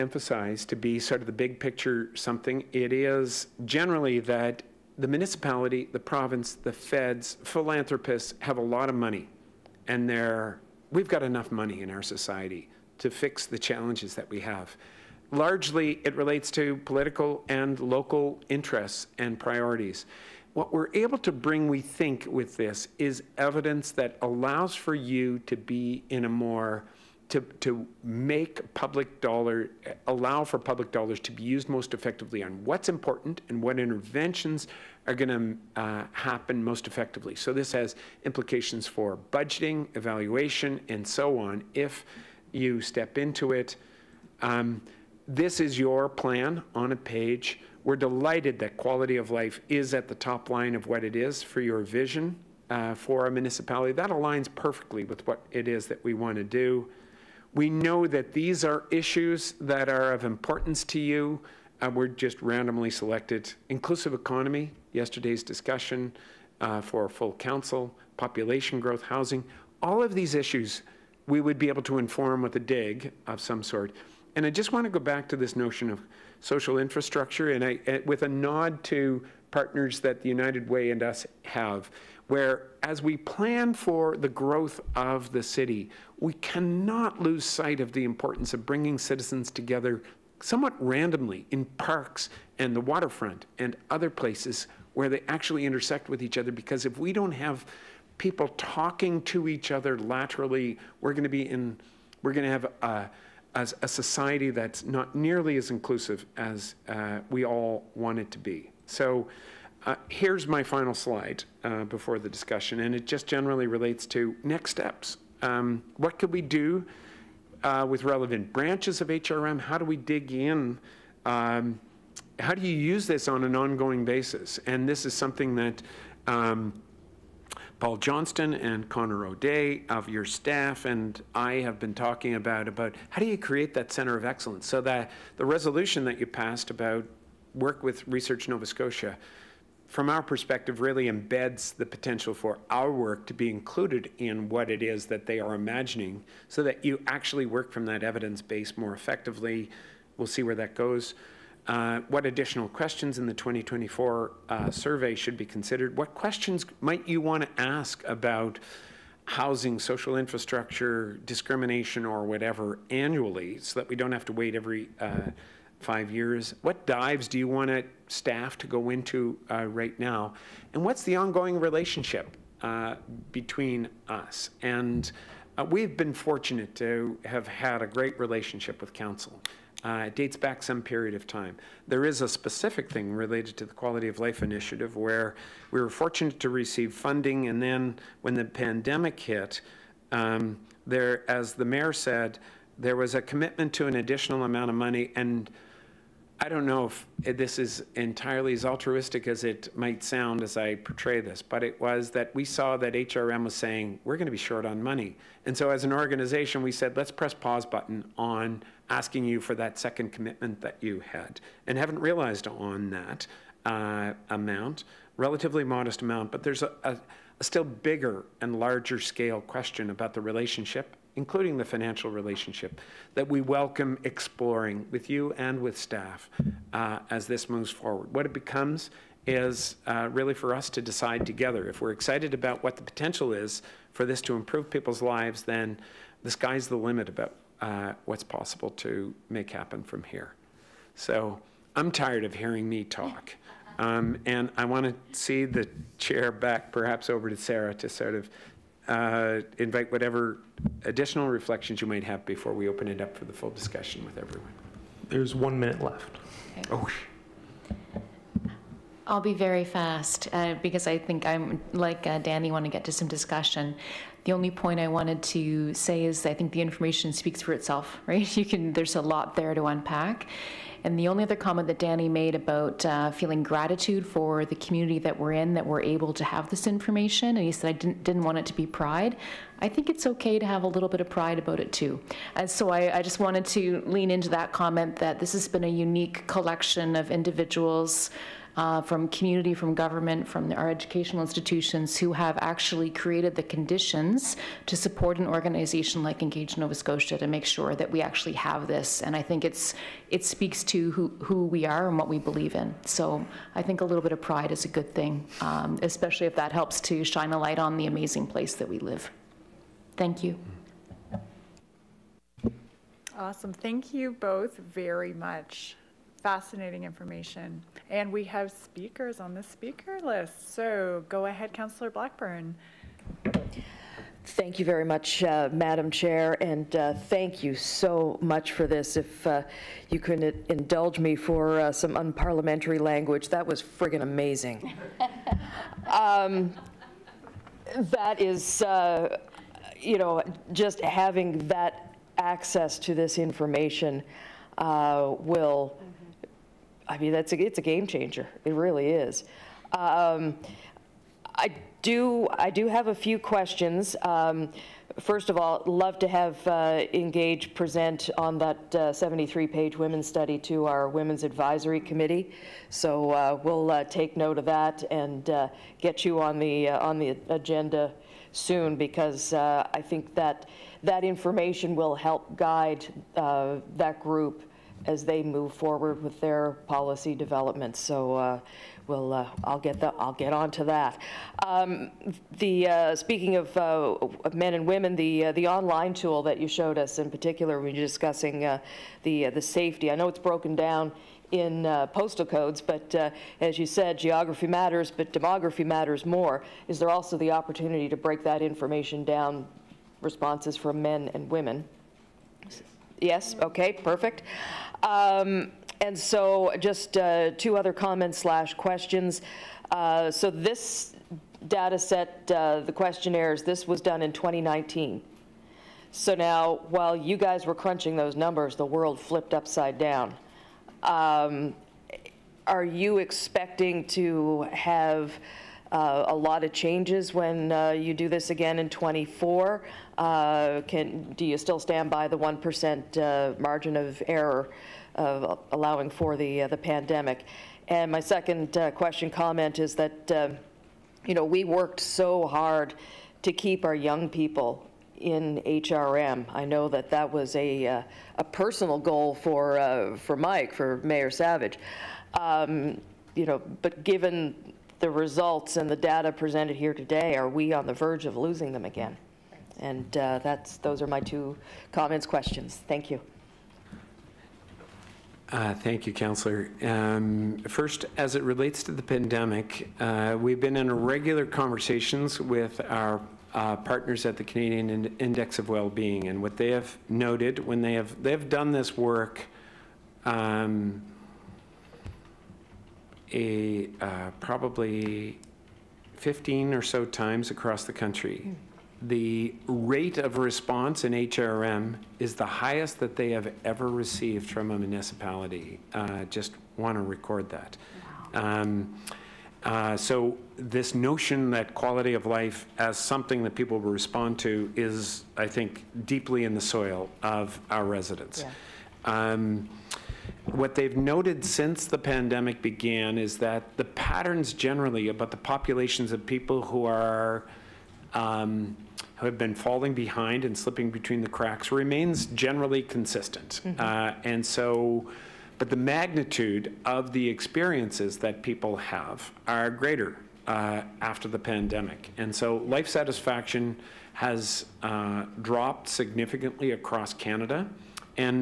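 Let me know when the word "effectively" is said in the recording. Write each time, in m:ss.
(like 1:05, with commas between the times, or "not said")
0:31, 0:36, 2:28.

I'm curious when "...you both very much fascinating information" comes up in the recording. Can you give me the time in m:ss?
5:13.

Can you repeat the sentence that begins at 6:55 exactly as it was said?
So now, while you guys were crunching those numbers, the world flipped upside down.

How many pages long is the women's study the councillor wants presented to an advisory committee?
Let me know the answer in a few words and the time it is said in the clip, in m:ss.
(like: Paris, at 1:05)
73, at 5:58.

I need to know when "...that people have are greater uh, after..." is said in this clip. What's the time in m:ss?
8:47.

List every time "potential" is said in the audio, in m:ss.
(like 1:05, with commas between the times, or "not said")
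2:21, 3:52.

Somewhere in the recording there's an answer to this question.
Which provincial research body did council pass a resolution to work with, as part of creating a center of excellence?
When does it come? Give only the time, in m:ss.
2:18.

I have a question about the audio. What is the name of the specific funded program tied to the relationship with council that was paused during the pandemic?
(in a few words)
Quality of Life Initiative.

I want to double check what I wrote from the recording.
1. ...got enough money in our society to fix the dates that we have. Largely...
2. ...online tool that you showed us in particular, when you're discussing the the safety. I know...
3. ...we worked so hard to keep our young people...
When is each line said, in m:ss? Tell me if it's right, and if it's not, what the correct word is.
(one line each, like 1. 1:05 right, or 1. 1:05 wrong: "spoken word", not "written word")
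1. 0:11 wrong: "challenges", not "dates"
2. 6:25 right
3. 7:21 right.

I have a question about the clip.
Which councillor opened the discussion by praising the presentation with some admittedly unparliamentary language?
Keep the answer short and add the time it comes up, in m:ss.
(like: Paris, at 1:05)
Blackburn, at 5:21.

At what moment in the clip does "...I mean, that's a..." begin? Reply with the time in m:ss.
5:46.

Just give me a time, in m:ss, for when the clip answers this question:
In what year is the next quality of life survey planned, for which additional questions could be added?
2:33.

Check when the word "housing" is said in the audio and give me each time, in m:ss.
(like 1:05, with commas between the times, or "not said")
1:09, 2:39.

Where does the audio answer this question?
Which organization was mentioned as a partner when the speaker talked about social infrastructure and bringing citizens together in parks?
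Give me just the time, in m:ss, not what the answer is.
1:20.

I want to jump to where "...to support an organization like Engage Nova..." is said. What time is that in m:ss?
4:54.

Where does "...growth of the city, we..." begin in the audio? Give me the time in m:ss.
1:24.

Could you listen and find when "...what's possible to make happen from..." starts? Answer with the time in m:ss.
3:58.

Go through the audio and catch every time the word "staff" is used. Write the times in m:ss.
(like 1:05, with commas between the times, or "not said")
2:10, 2:48, 3:45.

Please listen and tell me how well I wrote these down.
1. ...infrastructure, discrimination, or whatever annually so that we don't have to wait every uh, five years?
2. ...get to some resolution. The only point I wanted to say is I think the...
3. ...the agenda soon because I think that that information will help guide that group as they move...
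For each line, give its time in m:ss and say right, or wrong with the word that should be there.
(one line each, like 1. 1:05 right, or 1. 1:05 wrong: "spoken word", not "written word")
1. 2:40 right
2. 4:22 wrong: "discussion", not "resolution"
3. 6:06 right.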